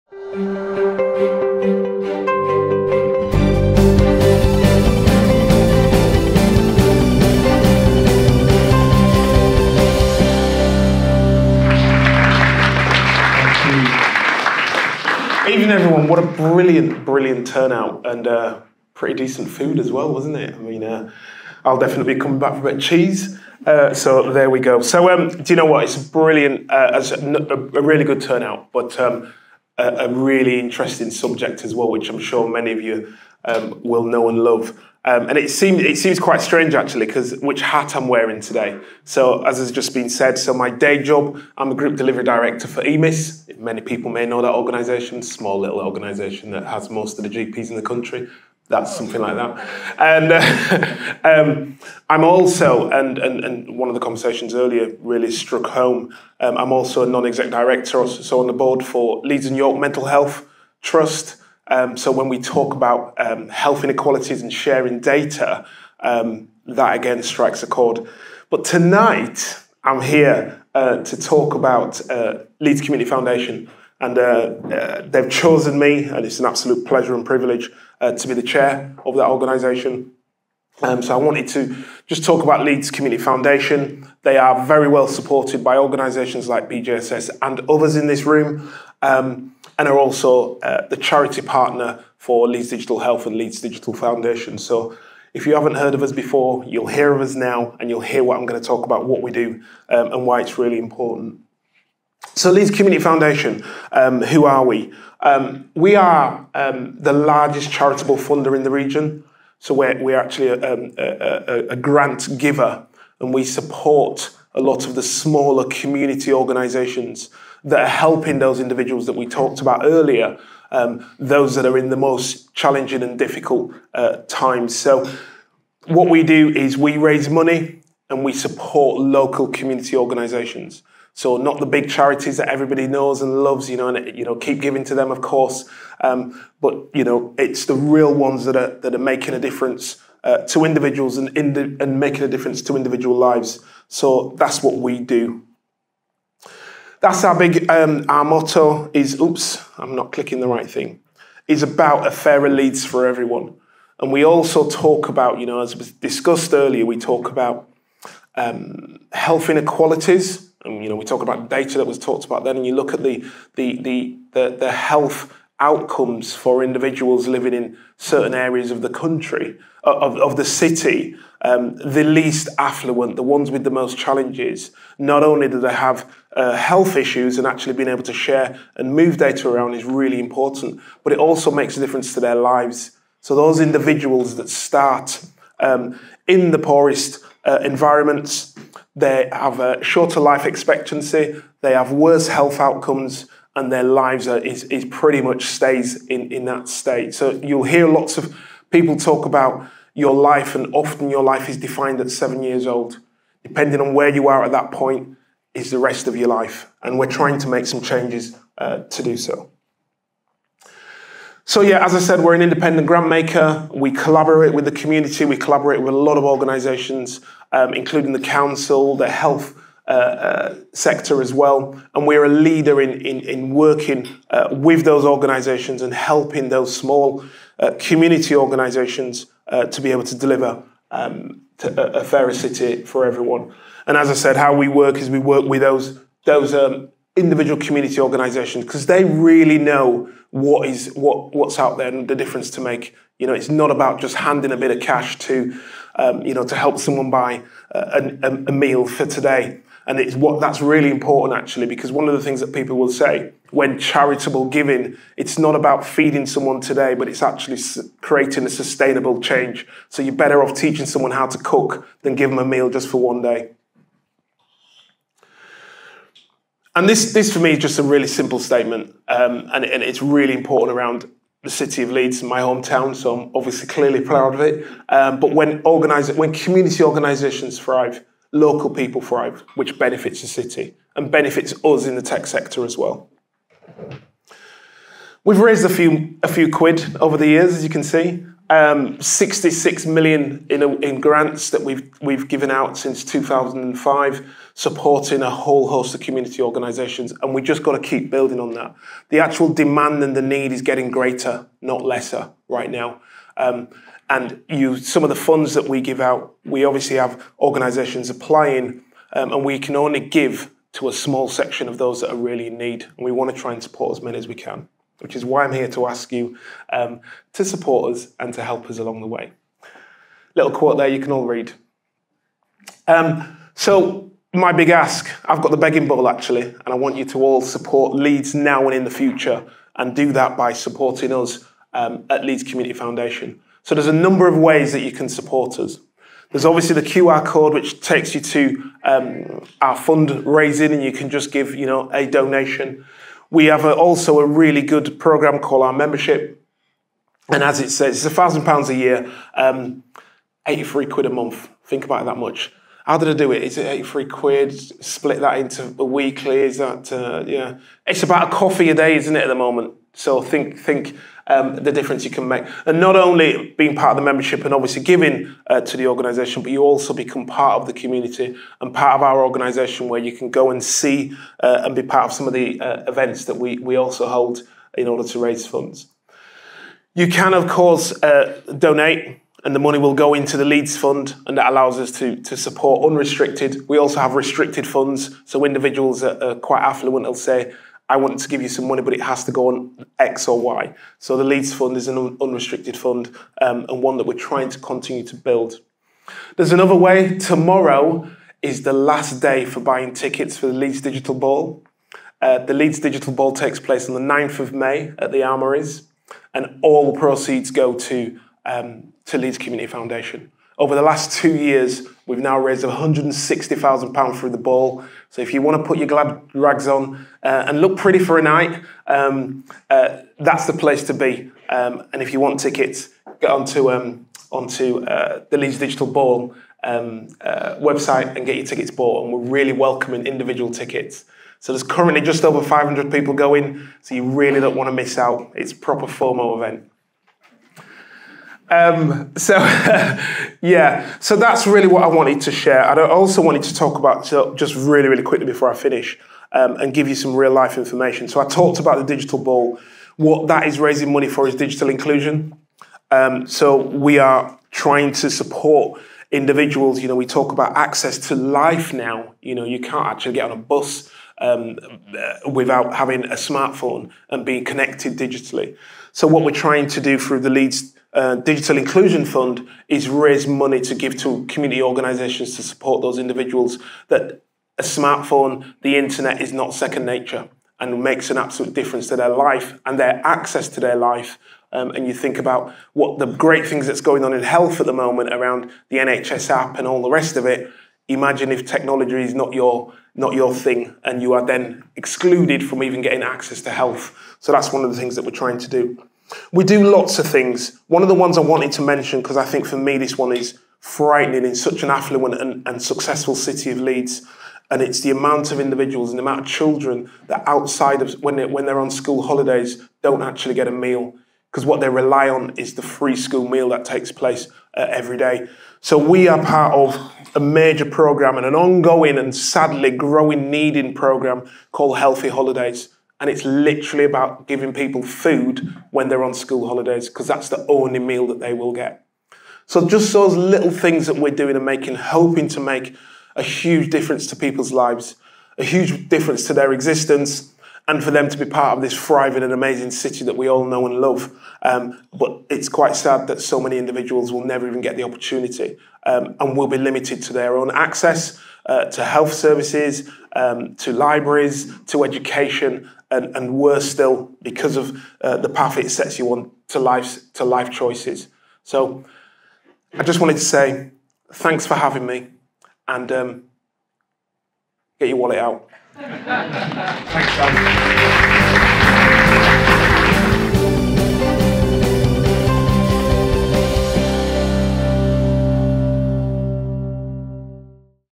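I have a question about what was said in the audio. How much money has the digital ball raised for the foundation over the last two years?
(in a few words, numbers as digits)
£160,000.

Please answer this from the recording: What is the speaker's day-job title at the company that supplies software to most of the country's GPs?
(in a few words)
Group delivery director.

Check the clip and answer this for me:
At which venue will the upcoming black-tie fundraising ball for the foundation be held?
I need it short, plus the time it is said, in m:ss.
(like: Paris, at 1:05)
The Armouries, at 6:45.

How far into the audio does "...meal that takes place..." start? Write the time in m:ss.
8:33.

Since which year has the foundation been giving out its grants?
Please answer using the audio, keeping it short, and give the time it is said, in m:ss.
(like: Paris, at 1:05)
2005, at 4:53.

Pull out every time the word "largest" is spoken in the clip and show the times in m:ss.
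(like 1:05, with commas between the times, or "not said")
1:47.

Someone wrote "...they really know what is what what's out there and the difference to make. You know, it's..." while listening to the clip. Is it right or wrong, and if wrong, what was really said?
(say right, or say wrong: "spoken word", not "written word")
right.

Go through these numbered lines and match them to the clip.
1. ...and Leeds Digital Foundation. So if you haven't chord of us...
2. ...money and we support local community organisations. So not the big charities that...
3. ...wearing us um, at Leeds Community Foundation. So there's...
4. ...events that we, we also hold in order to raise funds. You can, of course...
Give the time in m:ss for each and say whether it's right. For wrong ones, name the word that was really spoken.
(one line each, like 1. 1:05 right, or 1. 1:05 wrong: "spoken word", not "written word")
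1. 1:33 wrong: "heard", not "chord"
2. 2:07 right
3. 5:30 wrong: "supporting", not "wearing"
4. 6:12 right.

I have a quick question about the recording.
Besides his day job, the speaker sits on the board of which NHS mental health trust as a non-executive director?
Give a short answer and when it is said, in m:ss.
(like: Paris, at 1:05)
Leeds and York Mental Health Trust, at 0:59.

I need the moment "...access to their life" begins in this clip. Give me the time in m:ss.
8:00.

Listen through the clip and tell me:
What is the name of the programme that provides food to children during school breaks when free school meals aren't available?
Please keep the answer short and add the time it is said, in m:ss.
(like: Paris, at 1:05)
Healthy Holidays, at 8:41.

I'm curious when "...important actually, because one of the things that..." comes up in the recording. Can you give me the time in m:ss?
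4:10.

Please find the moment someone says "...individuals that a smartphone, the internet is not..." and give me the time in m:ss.
7:52.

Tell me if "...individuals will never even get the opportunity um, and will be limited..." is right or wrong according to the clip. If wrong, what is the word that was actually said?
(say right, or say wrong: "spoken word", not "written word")
right.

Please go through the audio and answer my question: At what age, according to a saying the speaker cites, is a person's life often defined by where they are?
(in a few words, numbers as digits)
7.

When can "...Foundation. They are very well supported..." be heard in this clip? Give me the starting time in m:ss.
1:23.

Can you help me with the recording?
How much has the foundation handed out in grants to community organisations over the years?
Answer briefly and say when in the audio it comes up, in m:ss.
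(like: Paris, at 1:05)
66 million, at 4:48.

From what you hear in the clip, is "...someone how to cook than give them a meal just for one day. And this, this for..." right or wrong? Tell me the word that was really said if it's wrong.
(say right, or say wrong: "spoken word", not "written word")
right.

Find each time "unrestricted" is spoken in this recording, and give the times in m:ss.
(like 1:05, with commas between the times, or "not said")
6:22, 6:32.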